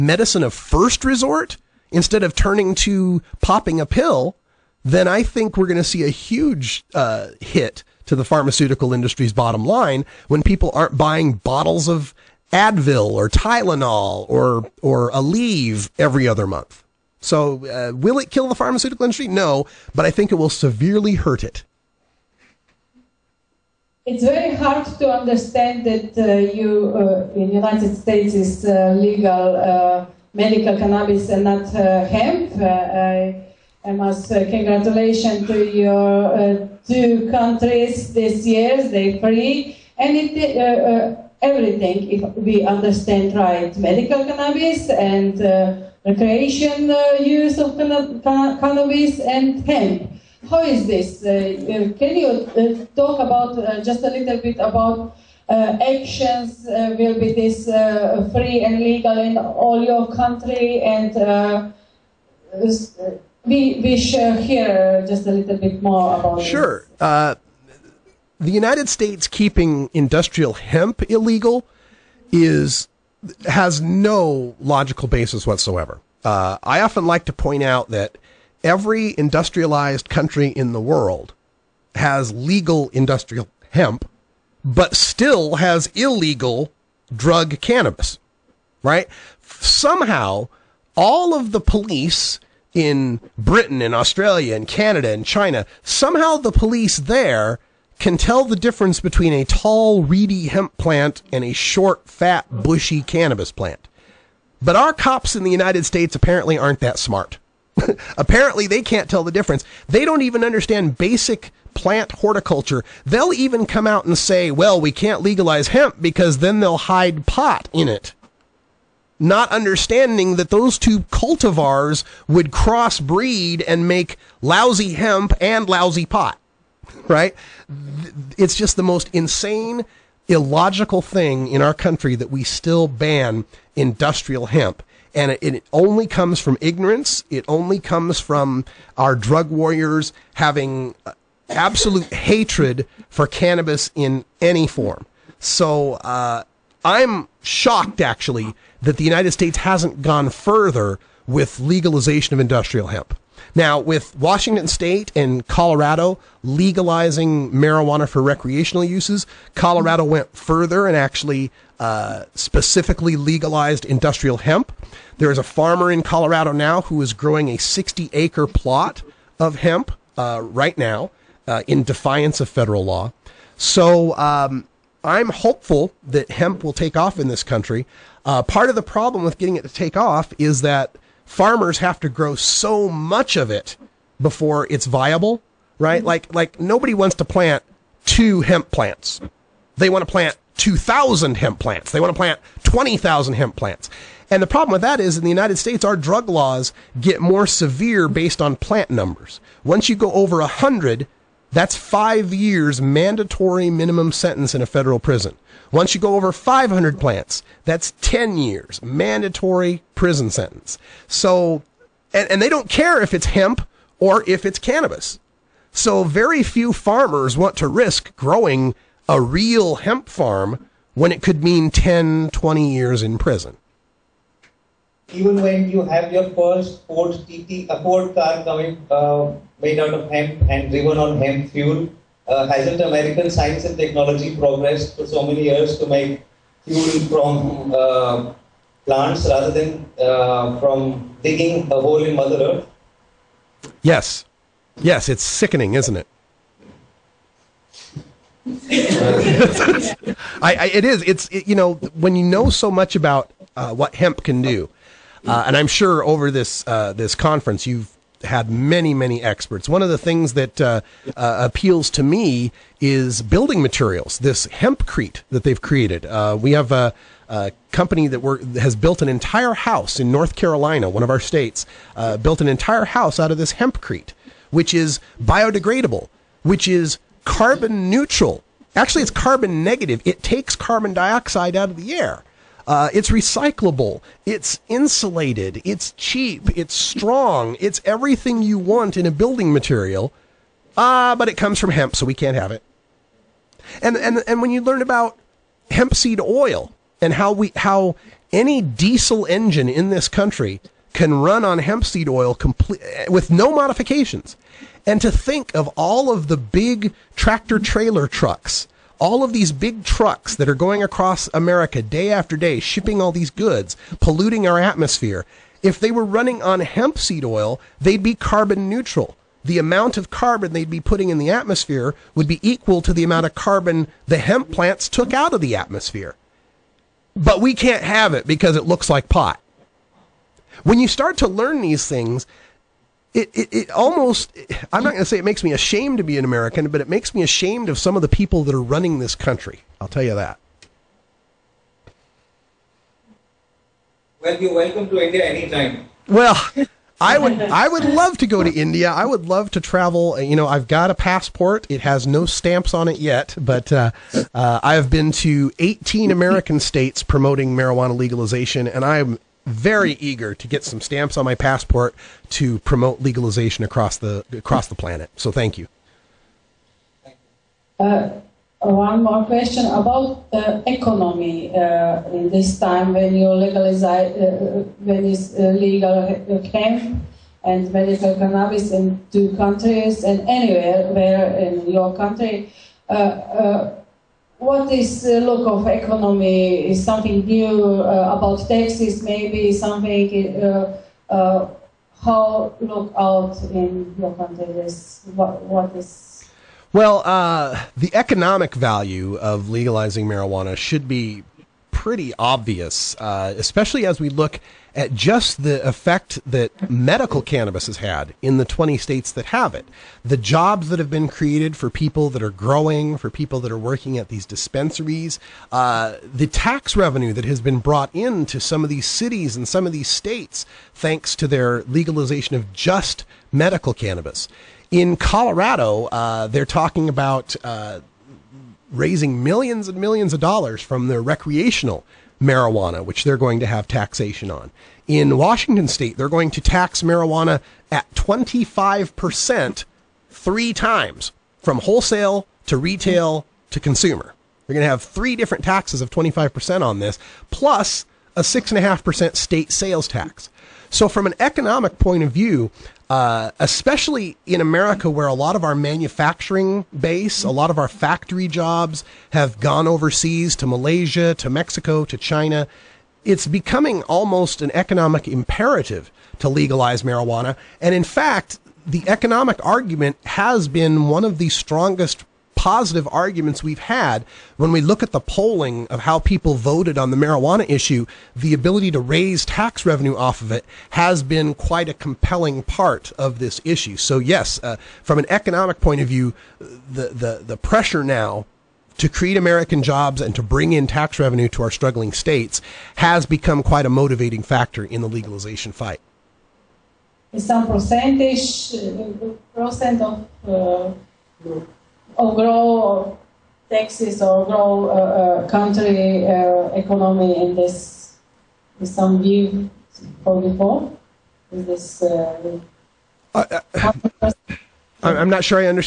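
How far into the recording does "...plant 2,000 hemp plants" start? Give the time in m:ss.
3:10.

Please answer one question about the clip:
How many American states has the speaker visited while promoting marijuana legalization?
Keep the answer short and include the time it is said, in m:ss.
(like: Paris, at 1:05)
18, at 5:55.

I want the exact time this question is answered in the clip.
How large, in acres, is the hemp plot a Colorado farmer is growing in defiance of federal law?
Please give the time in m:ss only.
2:47.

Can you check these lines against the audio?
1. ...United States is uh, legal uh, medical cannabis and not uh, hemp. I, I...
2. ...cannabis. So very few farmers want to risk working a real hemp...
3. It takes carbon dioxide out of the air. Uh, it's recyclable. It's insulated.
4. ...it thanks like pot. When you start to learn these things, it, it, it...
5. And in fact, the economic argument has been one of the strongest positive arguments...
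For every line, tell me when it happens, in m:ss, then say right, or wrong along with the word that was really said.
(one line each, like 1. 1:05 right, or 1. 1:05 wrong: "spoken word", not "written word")
1. 0:27 right
2. 3:34 wrong: "growing", not "working"
3. 4:40 right
4. 5:28 wrong: "looks", not "thanks"
5. 7:47 right.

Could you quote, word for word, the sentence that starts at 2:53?
So, um, I'm hopeful that hemp will take off in this country.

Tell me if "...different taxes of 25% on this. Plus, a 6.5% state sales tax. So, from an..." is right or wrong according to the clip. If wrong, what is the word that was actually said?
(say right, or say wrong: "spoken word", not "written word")
right.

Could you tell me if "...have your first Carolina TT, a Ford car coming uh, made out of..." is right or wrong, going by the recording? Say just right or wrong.
wrong.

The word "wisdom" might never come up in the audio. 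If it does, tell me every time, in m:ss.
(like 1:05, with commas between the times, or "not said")
not said.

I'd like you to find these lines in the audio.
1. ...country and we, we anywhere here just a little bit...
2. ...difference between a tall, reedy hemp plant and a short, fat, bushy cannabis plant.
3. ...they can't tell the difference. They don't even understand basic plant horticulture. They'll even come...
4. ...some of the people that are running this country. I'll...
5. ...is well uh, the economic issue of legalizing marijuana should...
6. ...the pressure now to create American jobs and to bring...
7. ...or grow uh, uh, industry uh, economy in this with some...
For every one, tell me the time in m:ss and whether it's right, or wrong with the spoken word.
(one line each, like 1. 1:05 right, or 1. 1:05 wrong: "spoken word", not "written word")
1. 1:00 wrong: "share", not "anywhere"
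2. 1:38 right
3. 1:48 right
4. 5:37 right
5. 6:35 wrong: "value", not "issue"
6. 8:07 right
7. 8:24 wrong: "country", not "industry".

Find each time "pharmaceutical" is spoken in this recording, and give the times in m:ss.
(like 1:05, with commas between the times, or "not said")
0:08, 0:18.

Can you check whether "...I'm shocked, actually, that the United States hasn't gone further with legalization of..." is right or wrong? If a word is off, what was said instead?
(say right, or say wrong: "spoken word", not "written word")
right.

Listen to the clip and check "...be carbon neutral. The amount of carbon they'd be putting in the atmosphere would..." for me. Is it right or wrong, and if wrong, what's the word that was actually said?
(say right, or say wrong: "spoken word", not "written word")
right.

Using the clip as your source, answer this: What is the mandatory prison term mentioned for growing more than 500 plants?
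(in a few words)
10 years.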